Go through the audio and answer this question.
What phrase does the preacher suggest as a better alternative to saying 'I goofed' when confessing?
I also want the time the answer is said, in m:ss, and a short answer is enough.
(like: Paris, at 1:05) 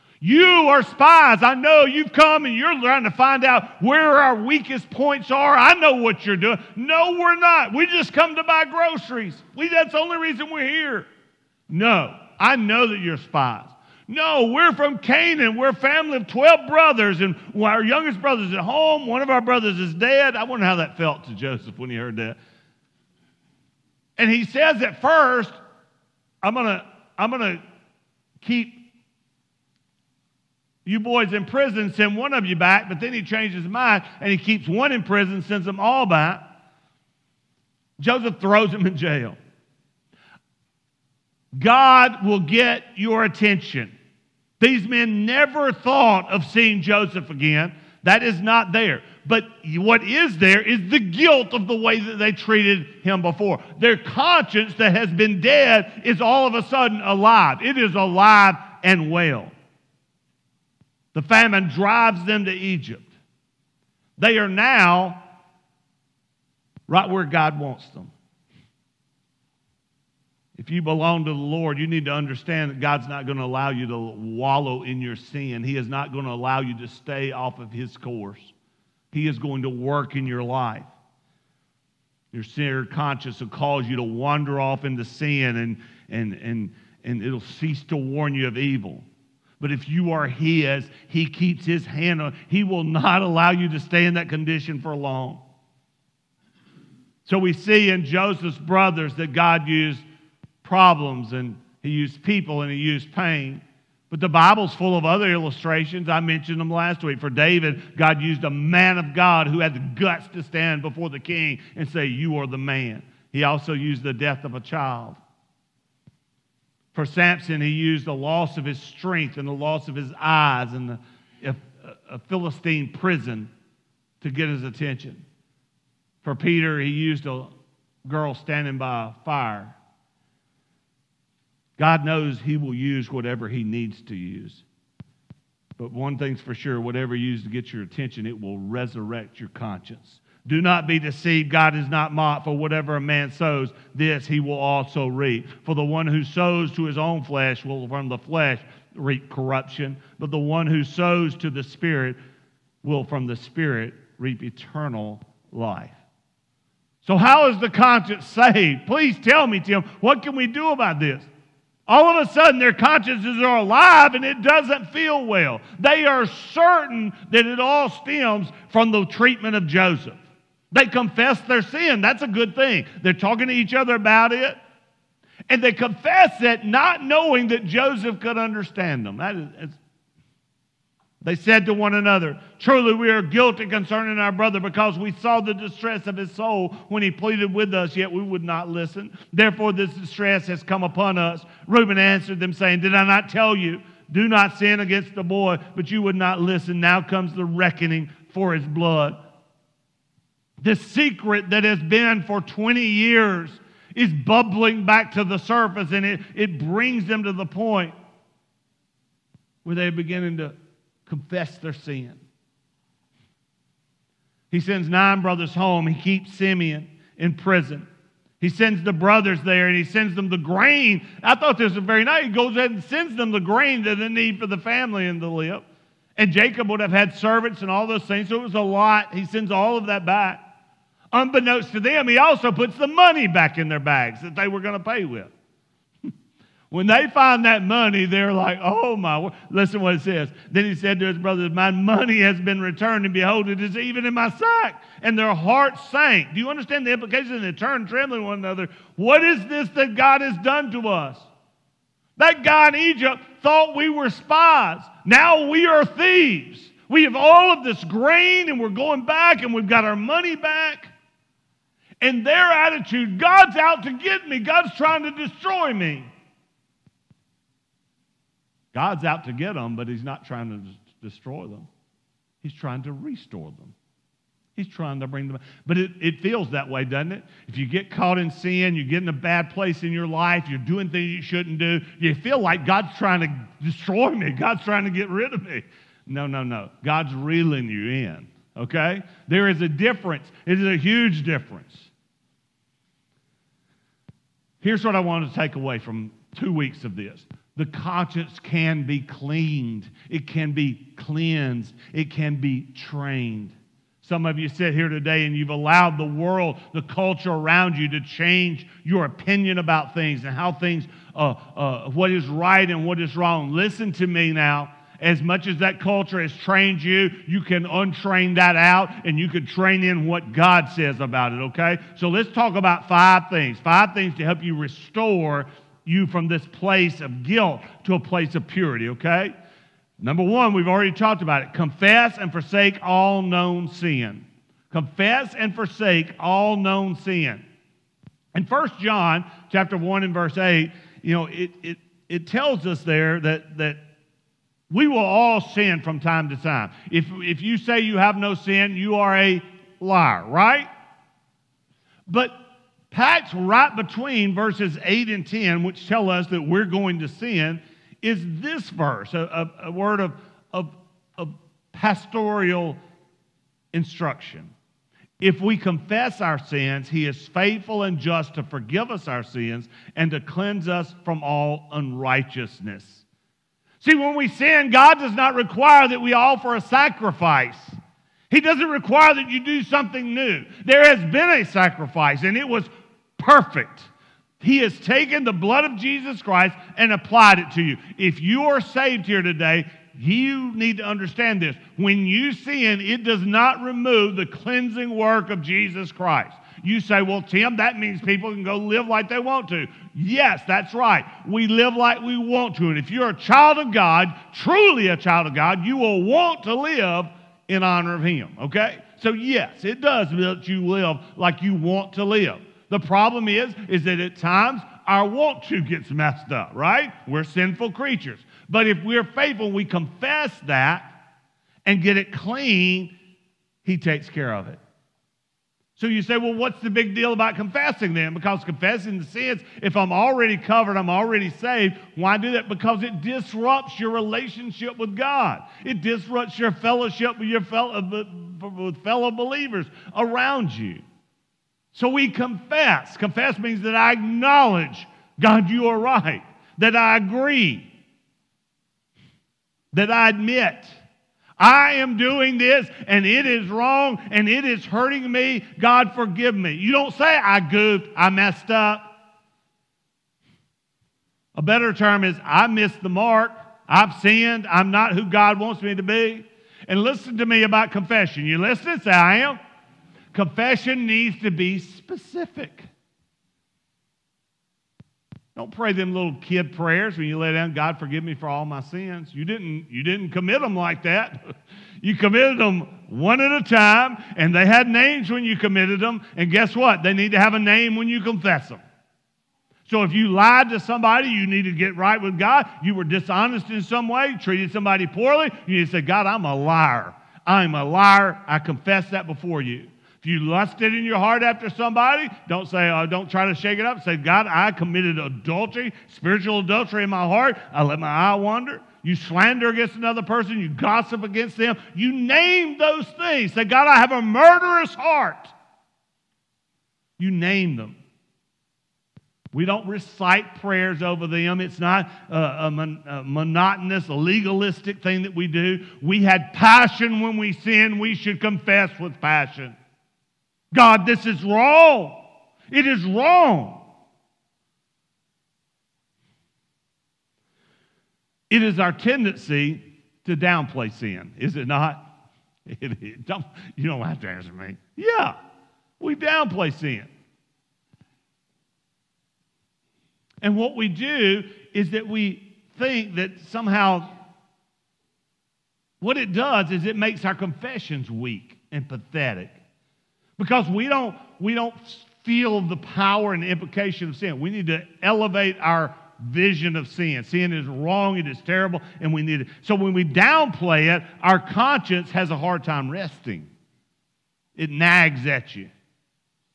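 I missed the mark, at 7:42.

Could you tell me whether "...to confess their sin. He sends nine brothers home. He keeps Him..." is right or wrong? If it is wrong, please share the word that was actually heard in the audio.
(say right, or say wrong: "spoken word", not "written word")
wrong: "Simeon", not "Him".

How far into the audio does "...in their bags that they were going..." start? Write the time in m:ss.
3:53.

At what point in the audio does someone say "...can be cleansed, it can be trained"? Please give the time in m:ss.
5:00.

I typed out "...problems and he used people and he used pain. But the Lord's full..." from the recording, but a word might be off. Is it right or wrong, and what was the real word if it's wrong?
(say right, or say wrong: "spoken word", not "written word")
wrong: "Bible", not "Lord".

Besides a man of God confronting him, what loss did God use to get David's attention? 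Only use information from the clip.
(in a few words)
the death of a child.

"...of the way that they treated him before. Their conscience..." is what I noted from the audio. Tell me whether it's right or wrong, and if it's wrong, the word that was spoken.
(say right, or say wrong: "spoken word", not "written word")
right.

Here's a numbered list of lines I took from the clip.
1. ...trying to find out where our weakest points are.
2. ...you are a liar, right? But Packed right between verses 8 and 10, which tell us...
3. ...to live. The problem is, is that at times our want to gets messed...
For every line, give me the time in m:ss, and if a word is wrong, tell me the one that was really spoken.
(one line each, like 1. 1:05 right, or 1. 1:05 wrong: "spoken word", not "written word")
1. 0:02 right
2. 5:48 right
3. 6:51 right.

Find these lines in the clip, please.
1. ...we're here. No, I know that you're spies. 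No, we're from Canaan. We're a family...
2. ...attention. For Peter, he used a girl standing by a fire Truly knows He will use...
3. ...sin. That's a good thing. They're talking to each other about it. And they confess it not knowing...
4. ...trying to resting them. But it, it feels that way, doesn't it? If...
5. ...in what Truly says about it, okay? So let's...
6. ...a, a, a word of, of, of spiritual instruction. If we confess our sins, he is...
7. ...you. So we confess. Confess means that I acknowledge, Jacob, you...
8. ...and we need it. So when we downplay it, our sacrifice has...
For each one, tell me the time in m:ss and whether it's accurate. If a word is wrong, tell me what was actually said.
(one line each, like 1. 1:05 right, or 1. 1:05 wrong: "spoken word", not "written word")
1. 0:10 right
2. 2:04 wrong: "God", not "Truly"
3. 2:51 right
4. 4:34 wrong: "bring", not "resting"
5. 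5:19 wrong: "God", not "Truly"
6. 5:59 wrong: "pastoral", not "spiritual"
7. 7:20 wrong: "God", not "Jacob"
8. 9:28 wrong: "conscience", not "sacrifice".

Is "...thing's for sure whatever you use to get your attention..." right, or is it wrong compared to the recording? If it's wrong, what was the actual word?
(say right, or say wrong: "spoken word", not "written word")
right.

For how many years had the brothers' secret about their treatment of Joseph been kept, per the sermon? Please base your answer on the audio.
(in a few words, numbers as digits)
20.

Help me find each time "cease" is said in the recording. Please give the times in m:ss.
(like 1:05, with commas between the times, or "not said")
1:27.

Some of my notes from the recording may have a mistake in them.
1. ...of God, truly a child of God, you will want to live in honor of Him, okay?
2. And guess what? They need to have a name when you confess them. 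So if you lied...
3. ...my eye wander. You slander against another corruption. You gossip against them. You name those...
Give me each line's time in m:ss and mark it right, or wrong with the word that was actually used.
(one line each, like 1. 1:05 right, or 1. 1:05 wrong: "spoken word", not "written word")
1. 6:43 right
2. 8:06 right
3. 8:27 wrong: "person", not "corruption".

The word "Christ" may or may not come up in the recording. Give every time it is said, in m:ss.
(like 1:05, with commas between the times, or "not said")
6:26, 6:35.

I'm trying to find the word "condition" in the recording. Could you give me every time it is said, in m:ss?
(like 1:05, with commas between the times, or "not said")
1:34.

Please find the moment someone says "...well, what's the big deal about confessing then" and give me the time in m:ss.
7:06.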